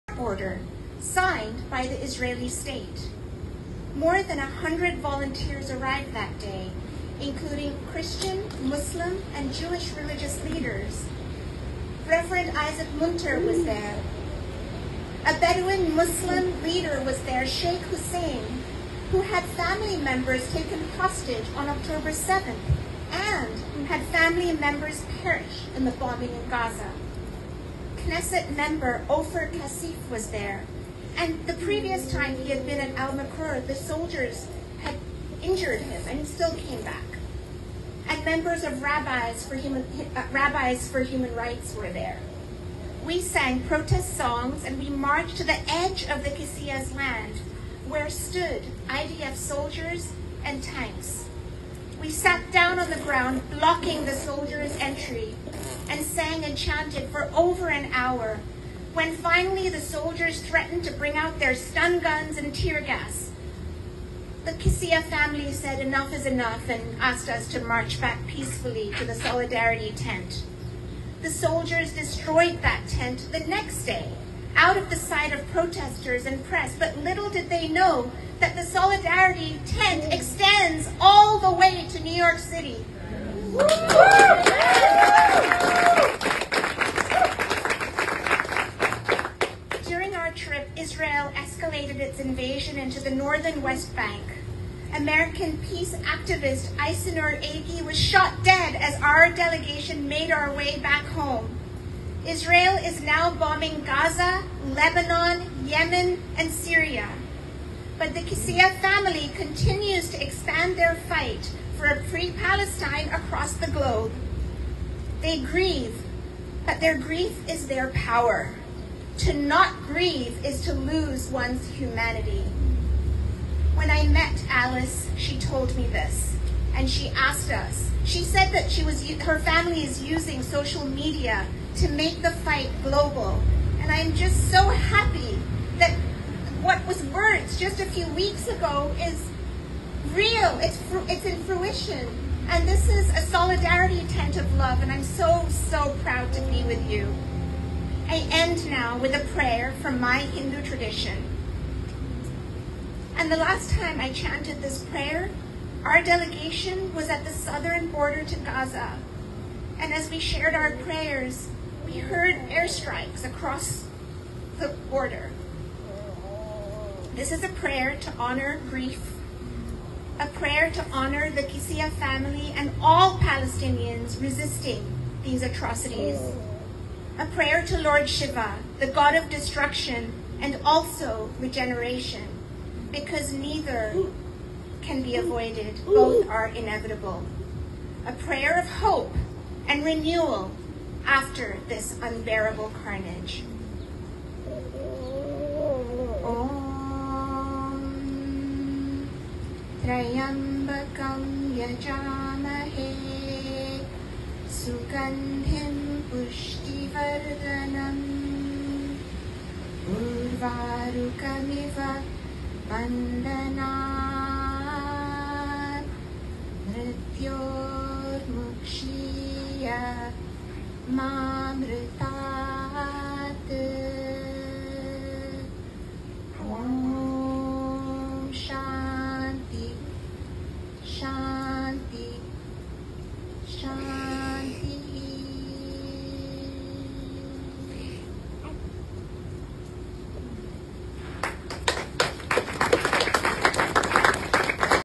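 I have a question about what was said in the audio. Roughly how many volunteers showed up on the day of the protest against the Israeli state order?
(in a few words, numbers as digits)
More than 100.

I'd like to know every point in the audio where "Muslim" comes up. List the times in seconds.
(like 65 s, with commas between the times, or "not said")
8 s, 15 s.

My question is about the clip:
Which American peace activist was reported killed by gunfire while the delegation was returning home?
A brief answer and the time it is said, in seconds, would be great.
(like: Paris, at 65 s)
Aysenur Eygi, at 96 s.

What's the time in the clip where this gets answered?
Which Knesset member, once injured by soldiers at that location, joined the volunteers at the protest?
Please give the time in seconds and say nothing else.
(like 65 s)
29 s.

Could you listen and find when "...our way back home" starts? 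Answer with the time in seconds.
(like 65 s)
100 s.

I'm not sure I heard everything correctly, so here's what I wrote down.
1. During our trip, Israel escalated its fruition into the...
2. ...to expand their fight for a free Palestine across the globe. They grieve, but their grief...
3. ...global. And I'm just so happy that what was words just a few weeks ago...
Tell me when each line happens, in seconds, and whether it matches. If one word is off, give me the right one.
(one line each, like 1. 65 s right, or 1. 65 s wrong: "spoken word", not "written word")
1. 89 s wrong: "invasion", not "fruition"
2. 110 s right
3. 132 s right.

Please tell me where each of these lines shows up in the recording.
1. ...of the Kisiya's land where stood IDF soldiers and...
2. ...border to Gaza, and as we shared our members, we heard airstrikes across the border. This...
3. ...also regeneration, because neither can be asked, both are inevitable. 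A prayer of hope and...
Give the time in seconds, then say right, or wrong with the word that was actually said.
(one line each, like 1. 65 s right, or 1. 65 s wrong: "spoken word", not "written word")
1. 46 s right
2. 157 s wrong: "prayers", not "members"
3. 180 s wrong: "avoided", not "asked".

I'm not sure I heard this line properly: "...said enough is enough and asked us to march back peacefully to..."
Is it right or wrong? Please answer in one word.
right.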